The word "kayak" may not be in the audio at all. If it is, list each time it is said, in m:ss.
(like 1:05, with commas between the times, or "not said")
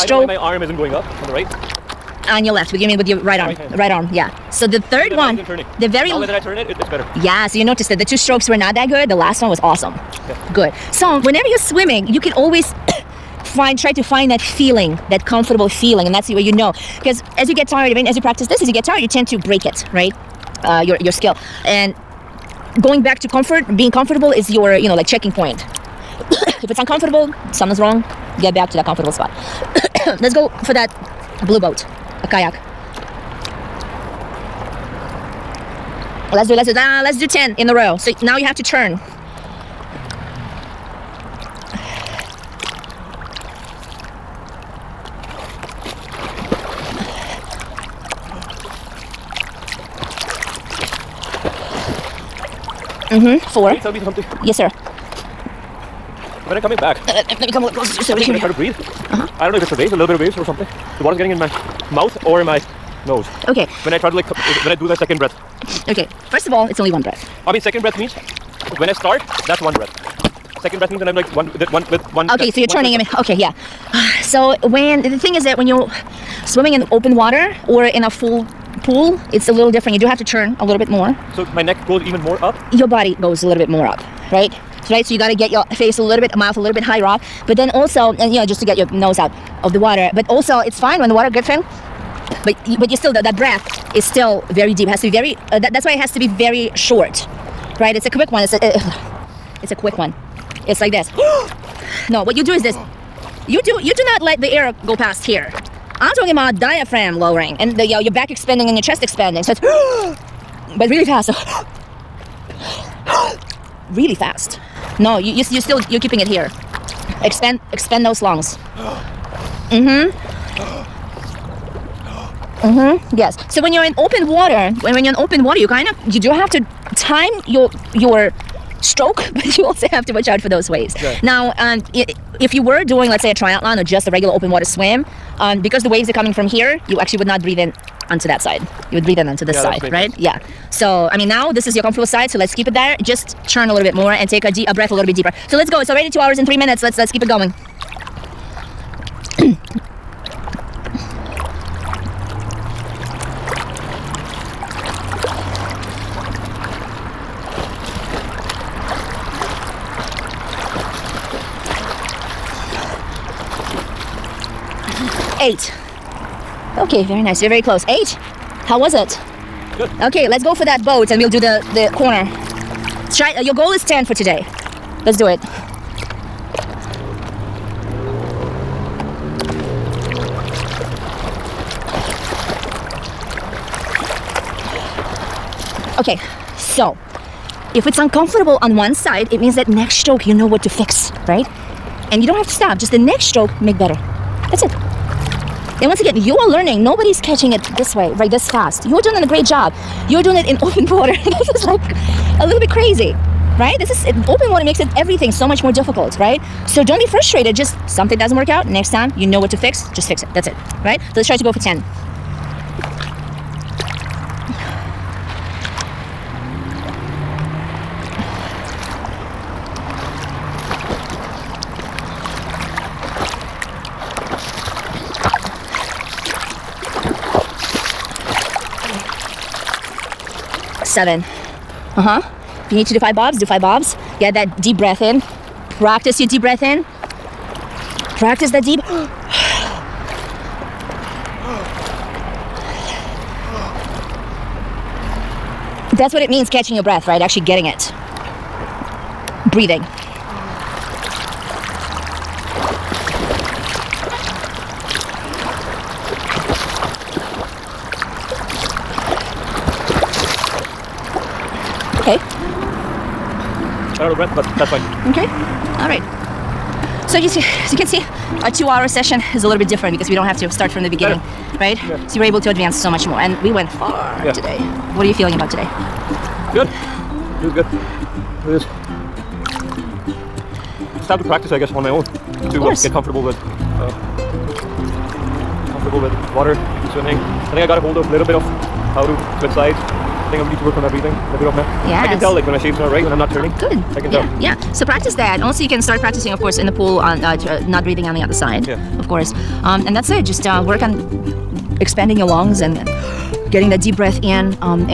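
0:32.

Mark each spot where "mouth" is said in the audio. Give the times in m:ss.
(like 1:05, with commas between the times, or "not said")
1:01, 1:26.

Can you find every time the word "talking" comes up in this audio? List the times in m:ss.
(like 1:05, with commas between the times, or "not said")
1:46.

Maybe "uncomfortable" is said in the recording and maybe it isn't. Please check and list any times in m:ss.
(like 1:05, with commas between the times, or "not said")
0:26, 3:07.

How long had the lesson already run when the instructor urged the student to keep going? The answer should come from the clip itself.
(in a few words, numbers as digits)
2 hours and 3 minutes.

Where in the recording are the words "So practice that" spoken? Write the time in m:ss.
4:54.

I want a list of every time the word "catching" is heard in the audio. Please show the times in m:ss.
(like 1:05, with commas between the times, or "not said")
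3:17, 4:06.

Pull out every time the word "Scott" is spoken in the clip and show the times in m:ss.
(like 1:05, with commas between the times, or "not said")
not said.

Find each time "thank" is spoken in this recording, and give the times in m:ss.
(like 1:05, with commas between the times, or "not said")
not said.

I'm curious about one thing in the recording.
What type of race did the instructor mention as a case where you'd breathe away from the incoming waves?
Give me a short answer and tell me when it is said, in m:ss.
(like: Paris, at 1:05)
Triathlon, at 2:13.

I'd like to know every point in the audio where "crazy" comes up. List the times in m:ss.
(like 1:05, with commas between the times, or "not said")
3:22.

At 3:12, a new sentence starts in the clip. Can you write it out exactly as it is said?
And you don't have to stop, just the next stroke make better.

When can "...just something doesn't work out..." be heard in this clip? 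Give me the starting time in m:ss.
3:27.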